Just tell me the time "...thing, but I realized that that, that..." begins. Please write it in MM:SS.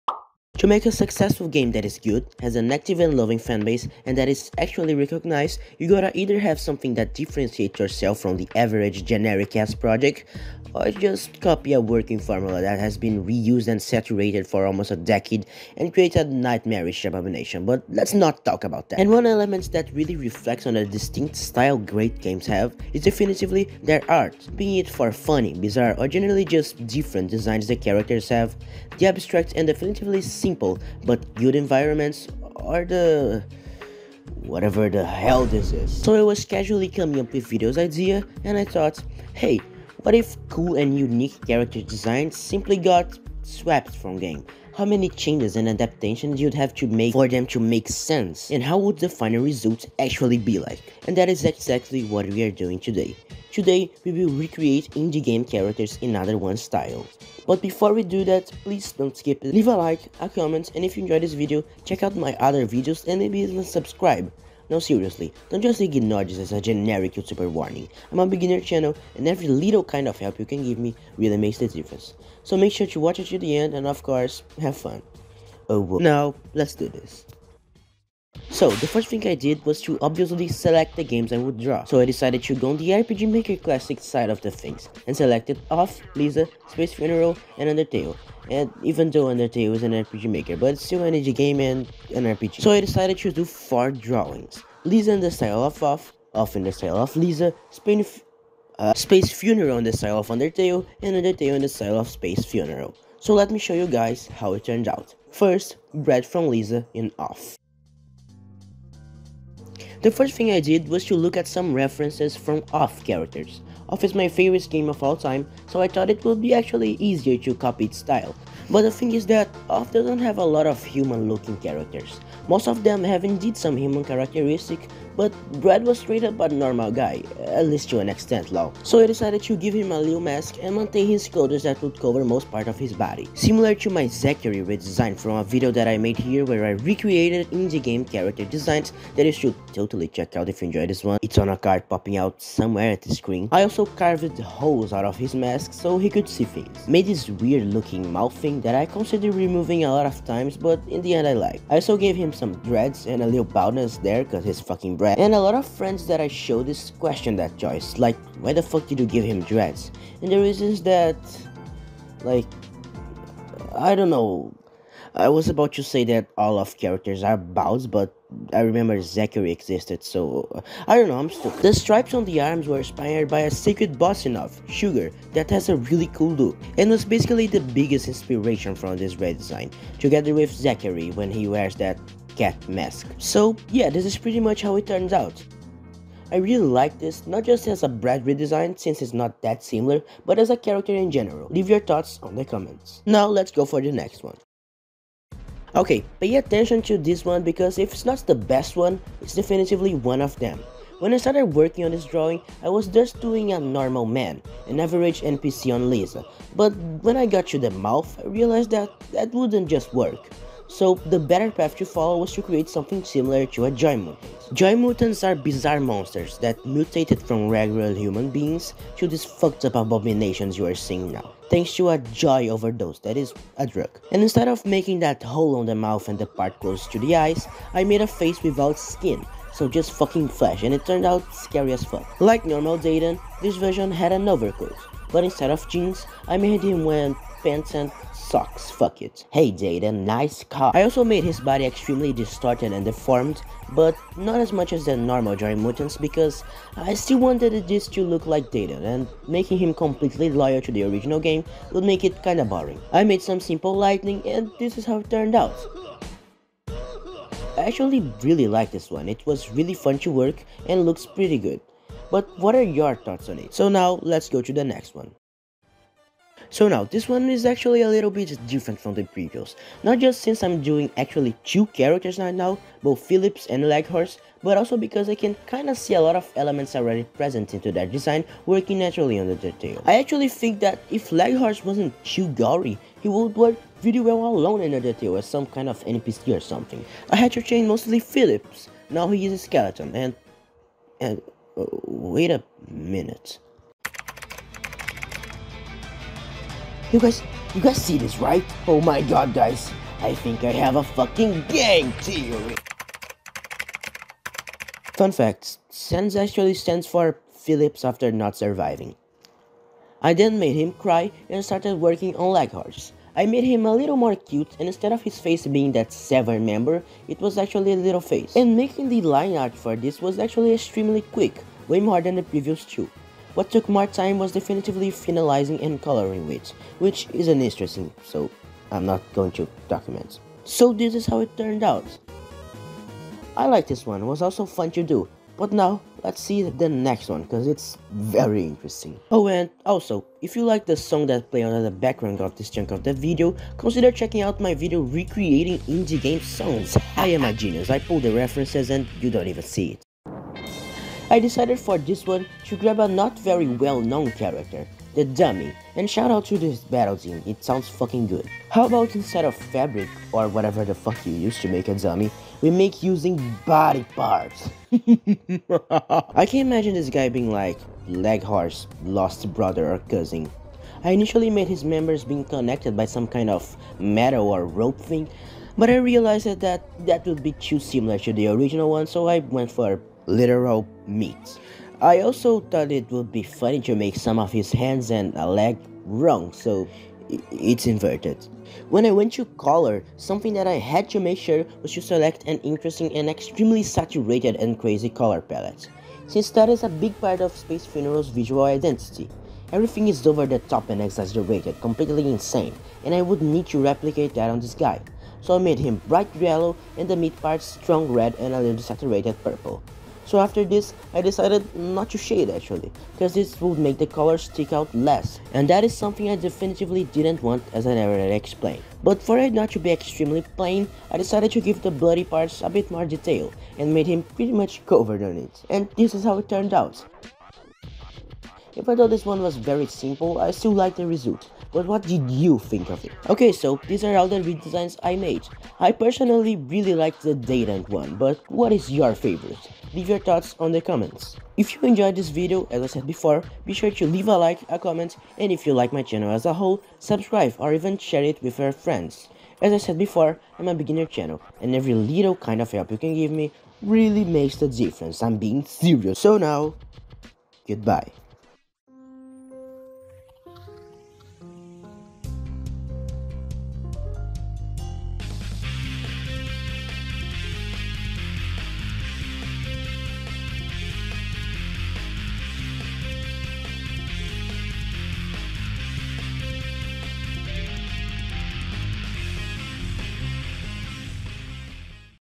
06:14.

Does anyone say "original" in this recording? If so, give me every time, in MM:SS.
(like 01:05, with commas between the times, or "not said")
04:10, 06:18.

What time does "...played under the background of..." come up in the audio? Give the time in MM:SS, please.
05:41.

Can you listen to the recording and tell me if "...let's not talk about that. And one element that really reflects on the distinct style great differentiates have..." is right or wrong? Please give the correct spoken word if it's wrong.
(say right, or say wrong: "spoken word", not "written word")
wrong: "games", not "differentiates".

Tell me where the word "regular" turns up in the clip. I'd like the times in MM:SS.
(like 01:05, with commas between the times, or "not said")
03:37.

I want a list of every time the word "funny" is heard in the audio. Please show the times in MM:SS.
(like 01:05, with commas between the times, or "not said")
00:25, 06:23.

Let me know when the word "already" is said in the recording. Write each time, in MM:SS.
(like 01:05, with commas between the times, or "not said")
04:36.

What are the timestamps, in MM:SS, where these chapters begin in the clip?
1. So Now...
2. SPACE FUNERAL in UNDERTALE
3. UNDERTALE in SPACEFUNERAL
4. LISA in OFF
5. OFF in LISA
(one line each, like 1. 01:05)
1. 07:13
2. 04:26
3. 05:50
4. 01:48
5. 03:15.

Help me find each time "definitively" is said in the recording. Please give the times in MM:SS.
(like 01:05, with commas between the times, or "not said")
00:23, 00:29, 03:19, 05:24, 06:56.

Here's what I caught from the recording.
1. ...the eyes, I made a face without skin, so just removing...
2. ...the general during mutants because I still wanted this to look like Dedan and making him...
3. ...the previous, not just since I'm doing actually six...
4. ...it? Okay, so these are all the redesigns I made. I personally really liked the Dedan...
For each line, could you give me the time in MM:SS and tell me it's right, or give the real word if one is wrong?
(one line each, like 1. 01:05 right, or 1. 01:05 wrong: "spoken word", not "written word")
1. 03:46 wrong: "fucking", not "removing"
2. 04:04 wrong: "normal", not "general"
3. 04:28 wrong: "two", not "six"
4. 07:12 right.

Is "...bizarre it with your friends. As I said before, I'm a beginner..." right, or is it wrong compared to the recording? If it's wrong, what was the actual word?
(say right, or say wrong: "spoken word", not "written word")
wrong: "share", not "bizarre".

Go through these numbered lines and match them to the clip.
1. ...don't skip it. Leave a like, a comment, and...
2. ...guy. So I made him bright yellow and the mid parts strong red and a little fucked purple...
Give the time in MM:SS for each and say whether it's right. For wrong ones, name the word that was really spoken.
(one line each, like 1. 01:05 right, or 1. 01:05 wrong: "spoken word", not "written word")
1. 00:58 right
2. 06:44 wrong: "saturated", not "fucked".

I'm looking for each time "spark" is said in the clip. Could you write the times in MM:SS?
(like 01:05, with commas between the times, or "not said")
not said.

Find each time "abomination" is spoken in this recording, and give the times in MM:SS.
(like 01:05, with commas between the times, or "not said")
00:17, 03:39.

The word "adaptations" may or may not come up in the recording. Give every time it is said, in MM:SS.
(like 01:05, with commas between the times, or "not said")
00:45.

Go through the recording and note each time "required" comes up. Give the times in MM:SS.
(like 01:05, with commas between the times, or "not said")
not said.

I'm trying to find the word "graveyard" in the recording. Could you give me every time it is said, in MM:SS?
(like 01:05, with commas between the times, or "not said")
not said.